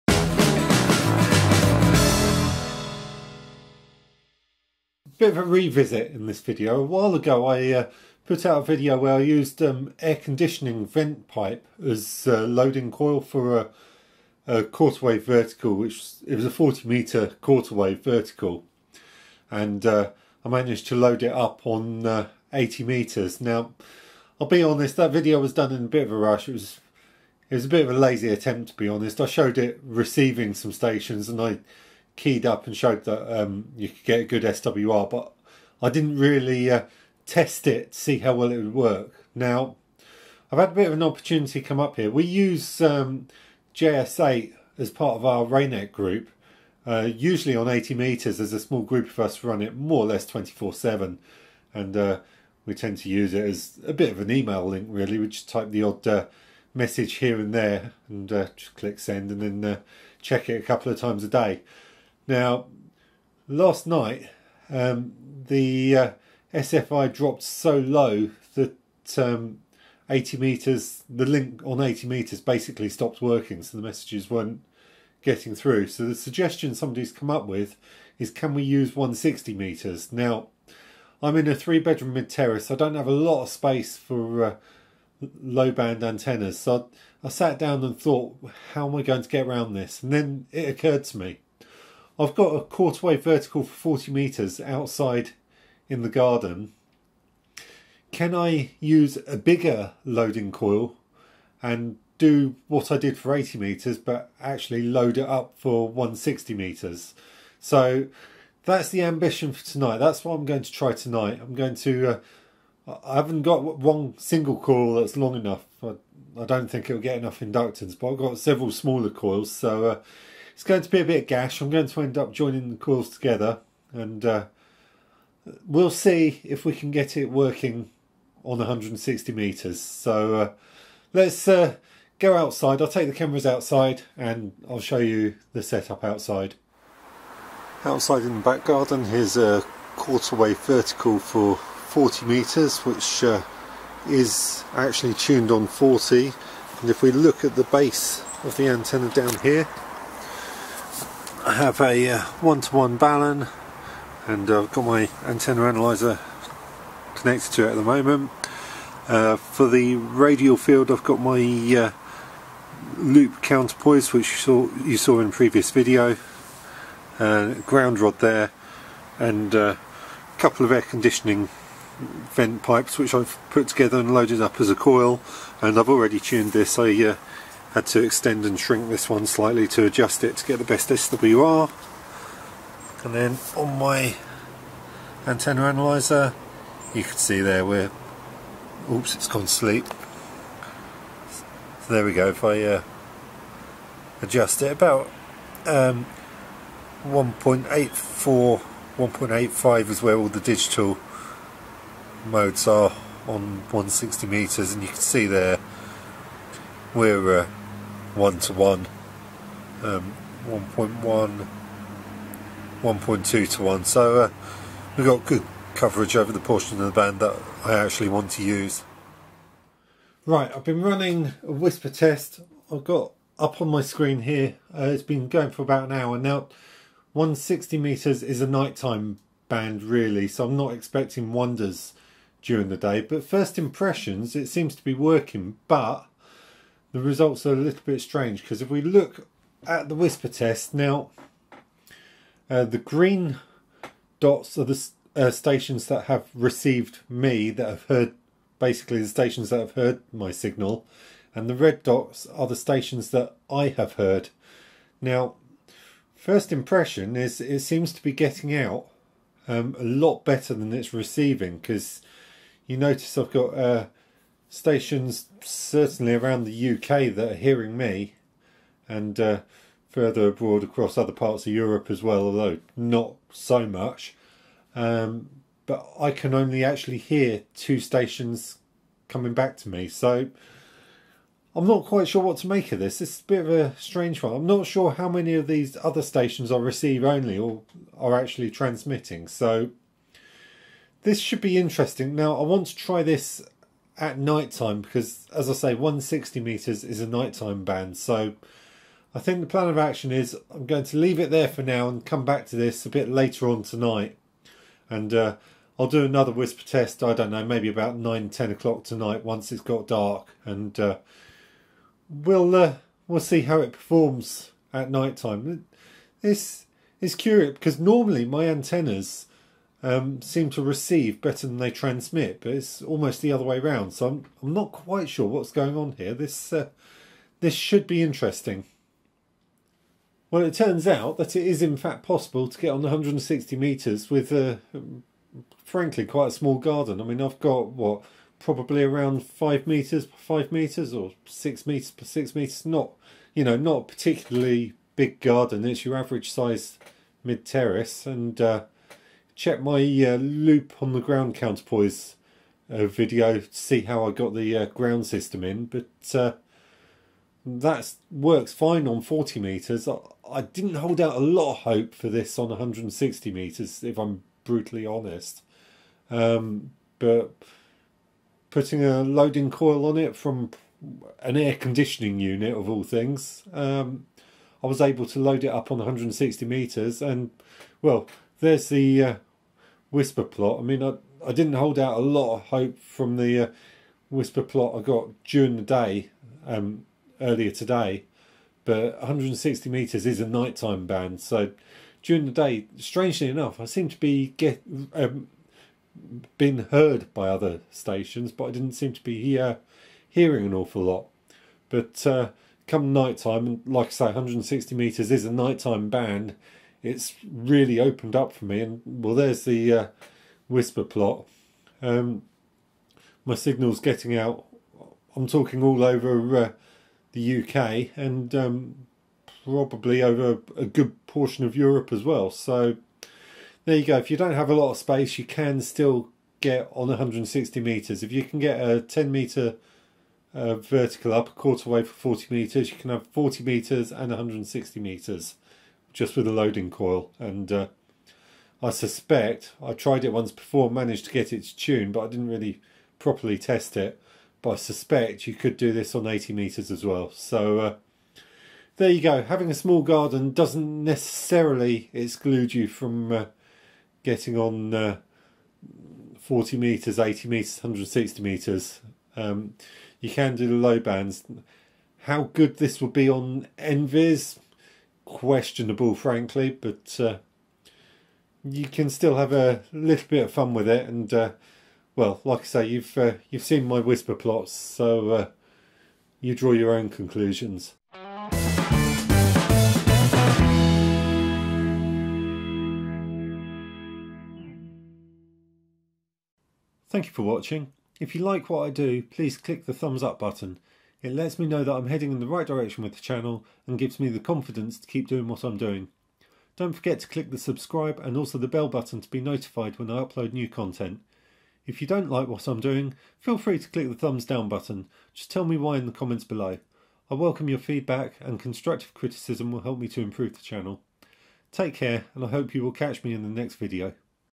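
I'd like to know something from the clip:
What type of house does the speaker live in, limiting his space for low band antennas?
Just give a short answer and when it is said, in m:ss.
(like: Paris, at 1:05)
Three bedroom mid terrace, at 1:21.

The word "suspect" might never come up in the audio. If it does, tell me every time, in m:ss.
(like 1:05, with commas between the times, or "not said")
7:18, 7:24.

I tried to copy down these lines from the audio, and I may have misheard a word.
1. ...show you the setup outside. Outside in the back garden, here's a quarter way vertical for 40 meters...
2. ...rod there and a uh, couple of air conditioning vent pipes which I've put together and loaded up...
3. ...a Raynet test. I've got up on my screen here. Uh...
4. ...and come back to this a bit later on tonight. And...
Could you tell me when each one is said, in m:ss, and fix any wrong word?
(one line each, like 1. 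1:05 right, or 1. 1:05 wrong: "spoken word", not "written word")
1. 2:14 right
2. 2:47 right
3. 3:41 wrong: "WSPR", not "Raynet"
4. 5:01 right.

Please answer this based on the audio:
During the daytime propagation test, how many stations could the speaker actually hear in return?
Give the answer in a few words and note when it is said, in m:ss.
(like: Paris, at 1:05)
2, at 4:37.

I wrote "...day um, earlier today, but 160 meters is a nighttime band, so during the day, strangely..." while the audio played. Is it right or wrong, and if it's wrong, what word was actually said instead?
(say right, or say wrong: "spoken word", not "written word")
right.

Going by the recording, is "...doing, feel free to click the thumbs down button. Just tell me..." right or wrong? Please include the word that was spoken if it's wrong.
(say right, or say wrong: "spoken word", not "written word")
right.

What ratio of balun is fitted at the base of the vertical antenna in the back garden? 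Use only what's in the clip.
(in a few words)
1:1.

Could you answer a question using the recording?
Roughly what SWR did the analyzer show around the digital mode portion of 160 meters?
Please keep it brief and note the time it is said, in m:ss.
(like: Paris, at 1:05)
1.1 to 1.2:1, at 3:30.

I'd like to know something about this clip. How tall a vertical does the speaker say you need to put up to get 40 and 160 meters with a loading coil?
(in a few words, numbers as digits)
10 meters.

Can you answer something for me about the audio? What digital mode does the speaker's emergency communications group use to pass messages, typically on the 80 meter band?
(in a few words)
JS8.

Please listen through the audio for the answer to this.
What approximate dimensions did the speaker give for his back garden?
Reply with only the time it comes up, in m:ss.
5:39.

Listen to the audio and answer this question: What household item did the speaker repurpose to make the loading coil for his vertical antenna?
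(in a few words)
Air conditioning vent pipe.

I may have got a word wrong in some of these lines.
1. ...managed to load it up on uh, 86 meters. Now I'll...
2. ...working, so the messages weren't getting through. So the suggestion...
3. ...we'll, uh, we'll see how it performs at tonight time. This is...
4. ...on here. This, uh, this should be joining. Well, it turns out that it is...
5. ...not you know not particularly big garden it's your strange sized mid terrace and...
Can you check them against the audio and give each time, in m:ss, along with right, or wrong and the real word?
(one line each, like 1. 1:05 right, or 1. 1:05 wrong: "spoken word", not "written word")
1. 0:20 wrong: "80", not "86"
2. 1:13 right
3. 5:12 wrong: "night", not "tonight"
4. 5:25 wrong: "interesting", not "joining"
5. 5:42 wrong: "average", not "strange".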